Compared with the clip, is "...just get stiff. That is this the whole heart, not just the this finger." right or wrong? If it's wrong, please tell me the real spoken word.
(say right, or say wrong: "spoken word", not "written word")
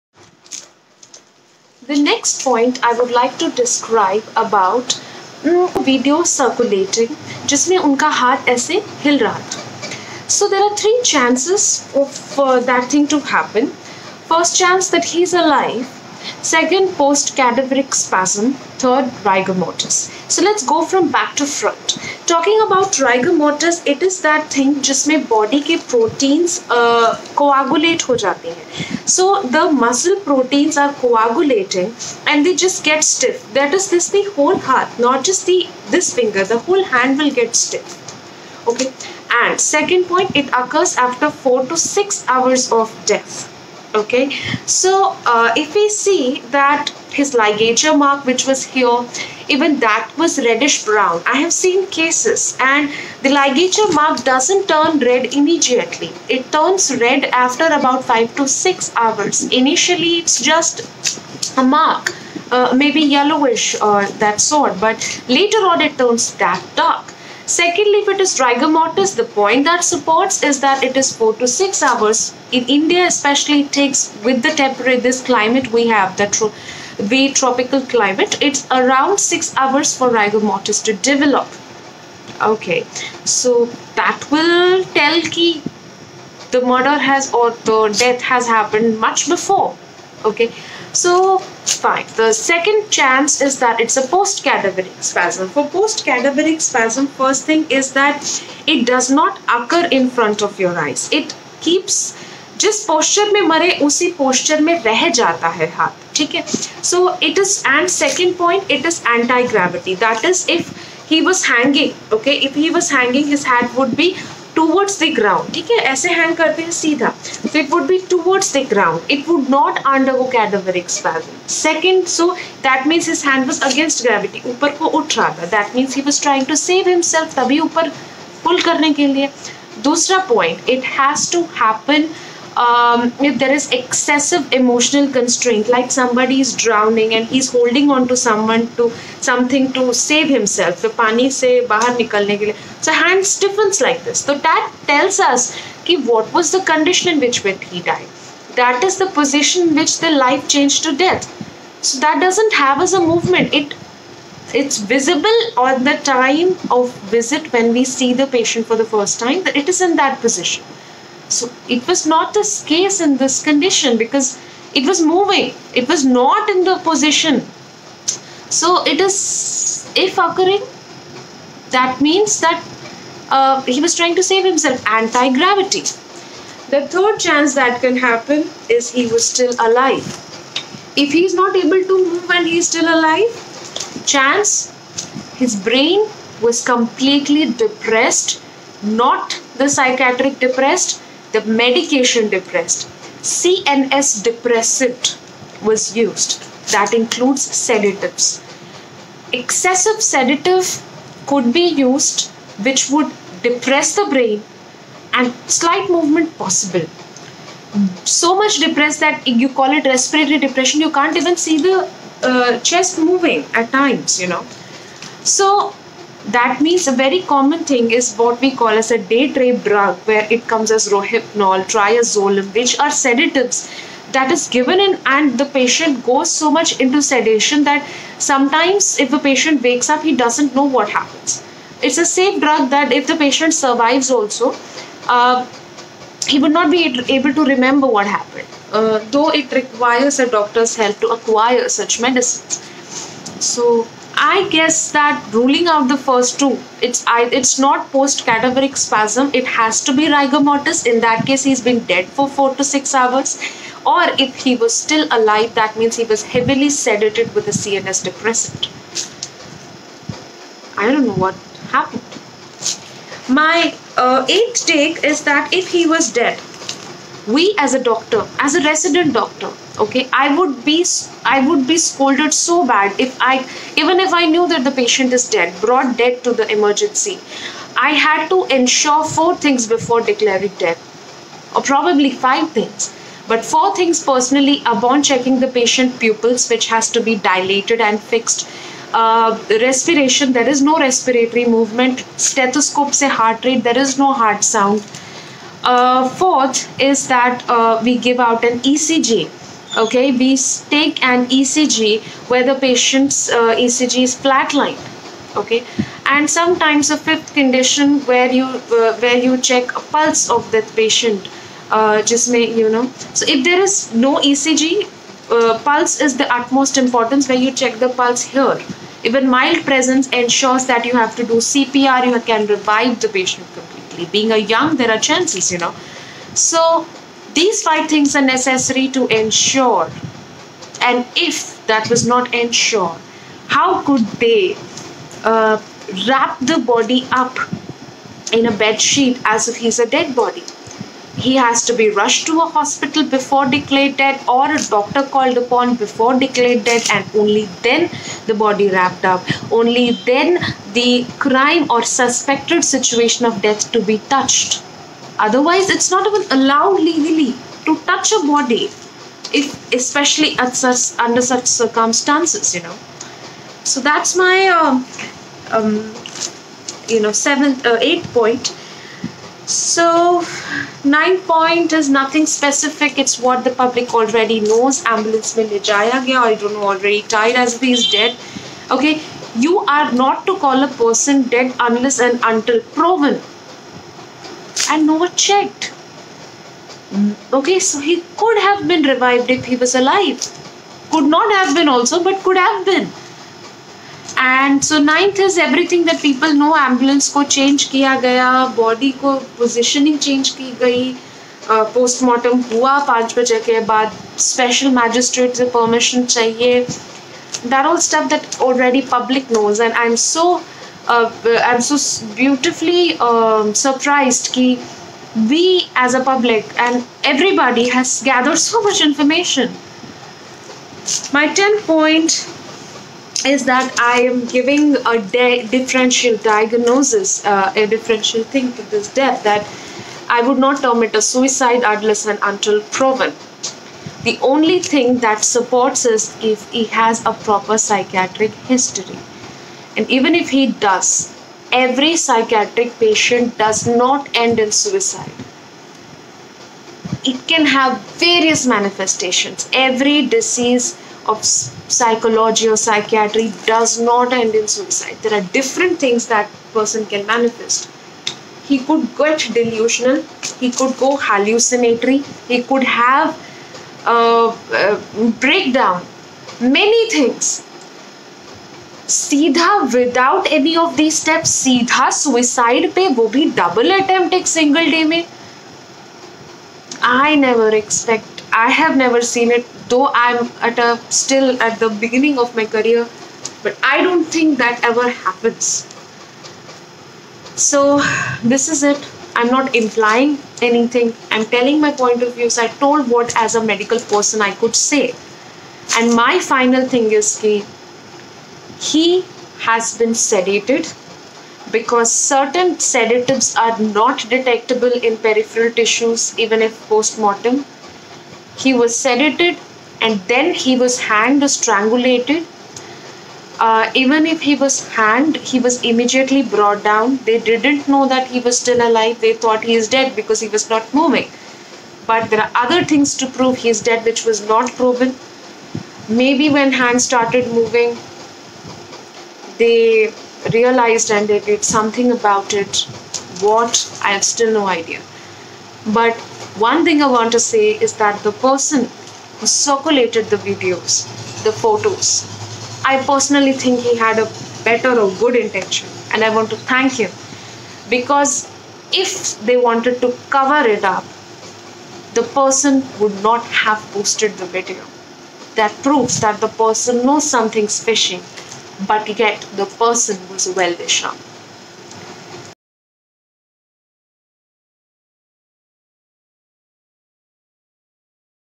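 right.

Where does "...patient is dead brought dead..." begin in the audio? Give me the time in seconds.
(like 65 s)
274 s.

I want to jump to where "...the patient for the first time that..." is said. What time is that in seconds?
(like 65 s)
158 s.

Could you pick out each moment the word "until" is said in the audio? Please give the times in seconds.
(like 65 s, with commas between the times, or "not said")
382 s, 432 s.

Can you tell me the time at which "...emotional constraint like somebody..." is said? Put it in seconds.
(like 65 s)
134 s.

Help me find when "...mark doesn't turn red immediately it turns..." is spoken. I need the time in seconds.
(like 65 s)
53 s.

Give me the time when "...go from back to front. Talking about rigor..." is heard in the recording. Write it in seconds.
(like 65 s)
20 s.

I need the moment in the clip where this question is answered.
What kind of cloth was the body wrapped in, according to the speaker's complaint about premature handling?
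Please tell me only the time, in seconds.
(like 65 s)
338 s.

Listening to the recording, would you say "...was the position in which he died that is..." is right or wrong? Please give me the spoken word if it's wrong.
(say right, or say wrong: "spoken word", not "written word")
wrong: "condition", not "position".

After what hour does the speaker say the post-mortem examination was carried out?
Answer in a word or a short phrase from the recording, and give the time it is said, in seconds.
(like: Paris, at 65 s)
5 o'clock, at 402 s.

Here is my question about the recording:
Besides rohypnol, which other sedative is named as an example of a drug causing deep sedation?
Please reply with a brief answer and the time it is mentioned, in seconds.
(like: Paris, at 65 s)
triazolam, at 221 s.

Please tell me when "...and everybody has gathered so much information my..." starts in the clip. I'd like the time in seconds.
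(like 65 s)
416 s.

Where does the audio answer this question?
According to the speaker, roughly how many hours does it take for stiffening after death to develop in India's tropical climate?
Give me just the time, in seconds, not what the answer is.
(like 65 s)
78 s.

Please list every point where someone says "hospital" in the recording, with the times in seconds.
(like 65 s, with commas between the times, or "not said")
342 s.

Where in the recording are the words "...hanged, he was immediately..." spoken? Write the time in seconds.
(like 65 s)
514 s.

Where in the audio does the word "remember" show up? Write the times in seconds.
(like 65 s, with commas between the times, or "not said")
237 s.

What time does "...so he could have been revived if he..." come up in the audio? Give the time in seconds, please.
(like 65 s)
387 s.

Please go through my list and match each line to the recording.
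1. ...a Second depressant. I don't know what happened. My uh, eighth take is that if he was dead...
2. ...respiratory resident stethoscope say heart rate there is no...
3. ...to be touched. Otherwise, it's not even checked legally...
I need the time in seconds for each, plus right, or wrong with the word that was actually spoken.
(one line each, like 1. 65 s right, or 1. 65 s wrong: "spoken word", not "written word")
1. 257 s wrong: "CNS", not "Second"
2. 290 s wrong: "movement", not "resident"
3. 353 s wrong: "allowed", not "checked".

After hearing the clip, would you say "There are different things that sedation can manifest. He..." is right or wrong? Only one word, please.
wrong.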